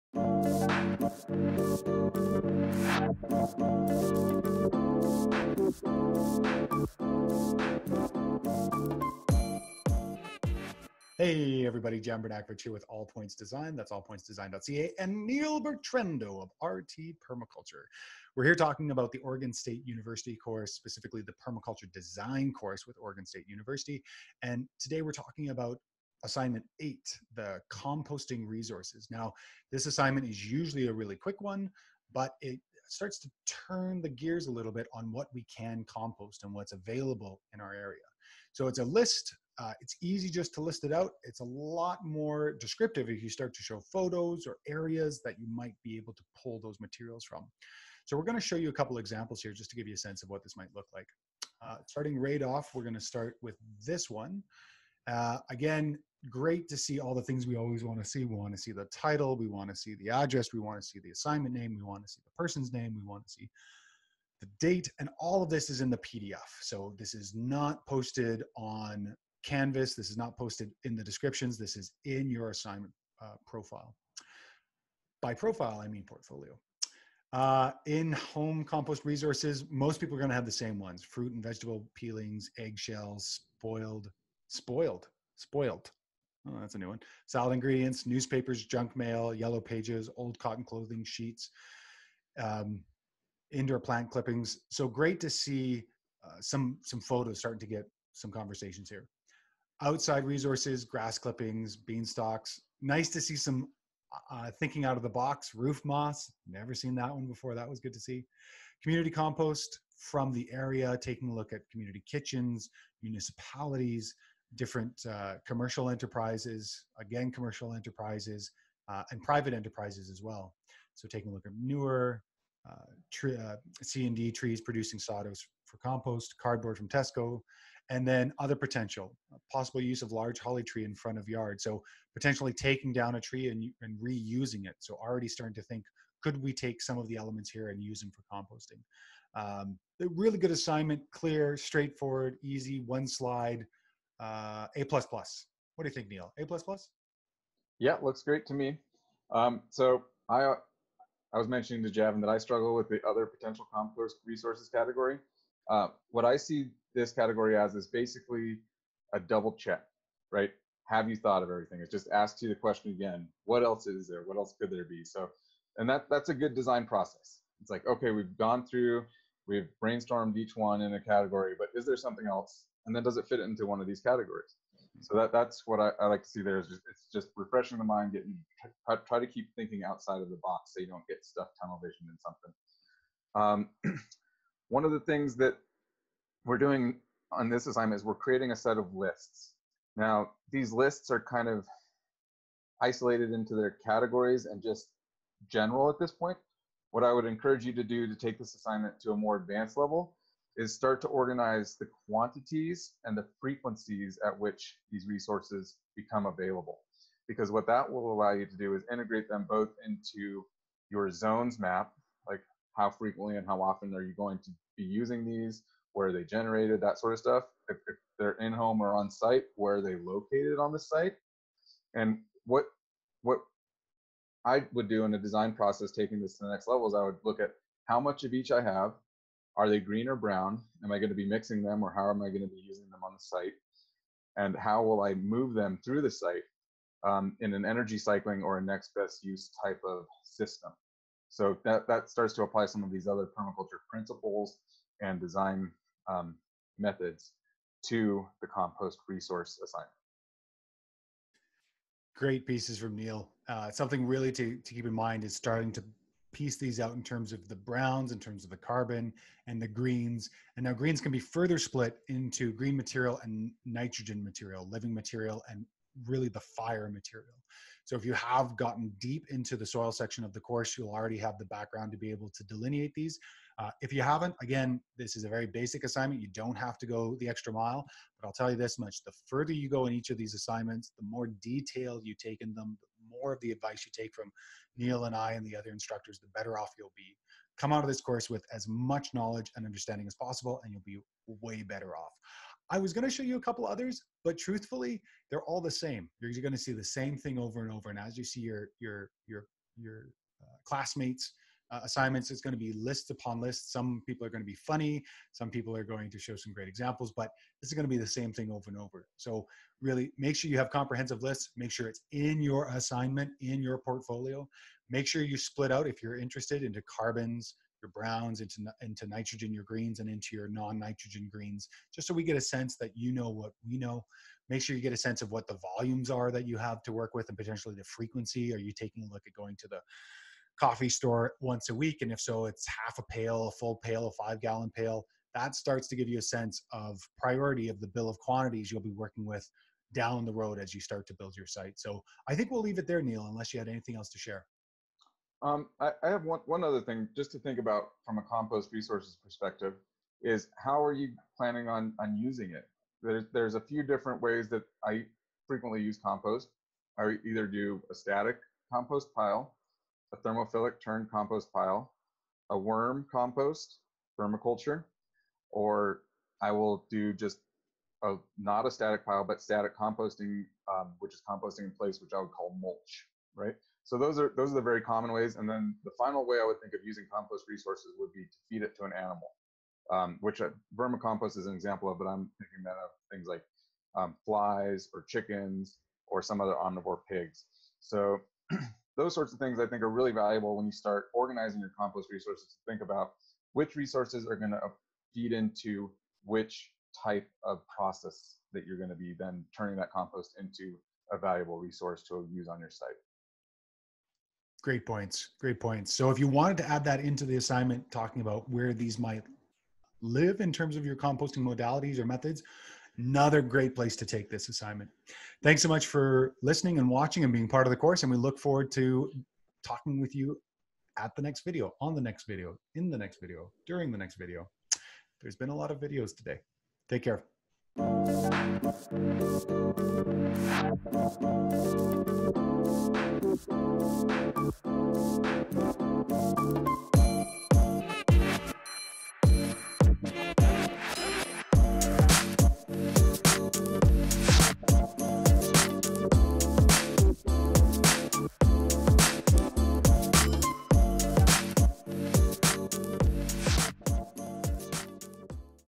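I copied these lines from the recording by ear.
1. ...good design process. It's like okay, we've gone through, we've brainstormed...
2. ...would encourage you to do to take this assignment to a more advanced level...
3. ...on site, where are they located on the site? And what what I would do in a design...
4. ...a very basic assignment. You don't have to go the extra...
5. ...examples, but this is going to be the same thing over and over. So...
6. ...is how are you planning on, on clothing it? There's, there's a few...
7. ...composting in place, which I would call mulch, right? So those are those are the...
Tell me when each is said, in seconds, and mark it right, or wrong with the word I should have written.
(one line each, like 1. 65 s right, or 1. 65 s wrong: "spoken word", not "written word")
1. 166 s right
2. 197 s right
3. 218 s right
4. 275 s right
5. 306 s right
6. 350 s wrong: "using", not "clothing"
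7. 371 s right.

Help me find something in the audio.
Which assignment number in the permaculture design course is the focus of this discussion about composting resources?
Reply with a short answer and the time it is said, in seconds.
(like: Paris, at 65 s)
8, at 26 s.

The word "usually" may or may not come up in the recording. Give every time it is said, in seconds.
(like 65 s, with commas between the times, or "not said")
30 s.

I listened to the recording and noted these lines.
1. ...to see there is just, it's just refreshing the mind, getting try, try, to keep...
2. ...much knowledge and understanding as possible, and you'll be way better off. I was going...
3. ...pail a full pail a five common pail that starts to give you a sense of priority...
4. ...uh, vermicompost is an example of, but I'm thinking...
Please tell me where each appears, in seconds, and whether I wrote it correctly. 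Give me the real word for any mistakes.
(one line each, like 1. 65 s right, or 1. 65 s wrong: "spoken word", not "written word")
1. 176 s right
2. 288 s right
3. 333 s wrong: "gallon", not "common"
4. 380 s right.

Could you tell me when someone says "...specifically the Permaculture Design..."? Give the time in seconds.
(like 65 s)
20 s.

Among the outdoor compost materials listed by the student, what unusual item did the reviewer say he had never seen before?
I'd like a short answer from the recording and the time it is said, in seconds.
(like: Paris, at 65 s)
Roof moss, at 105 s.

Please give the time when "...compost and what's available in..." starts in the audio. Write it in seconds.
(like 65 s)
35 s.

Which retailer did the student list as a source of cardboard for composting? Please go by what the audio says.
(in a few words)
Tesco.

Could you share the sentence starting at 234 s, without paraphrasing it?
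And how will I move them through the site um, in an energy cycling or a next best use type of system?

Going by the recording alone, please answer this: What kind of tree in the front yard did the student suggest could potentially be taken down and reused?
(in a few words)
Holly tree.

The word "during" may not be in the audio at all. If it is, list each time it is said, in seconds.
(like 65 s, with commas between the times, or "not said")
423 s.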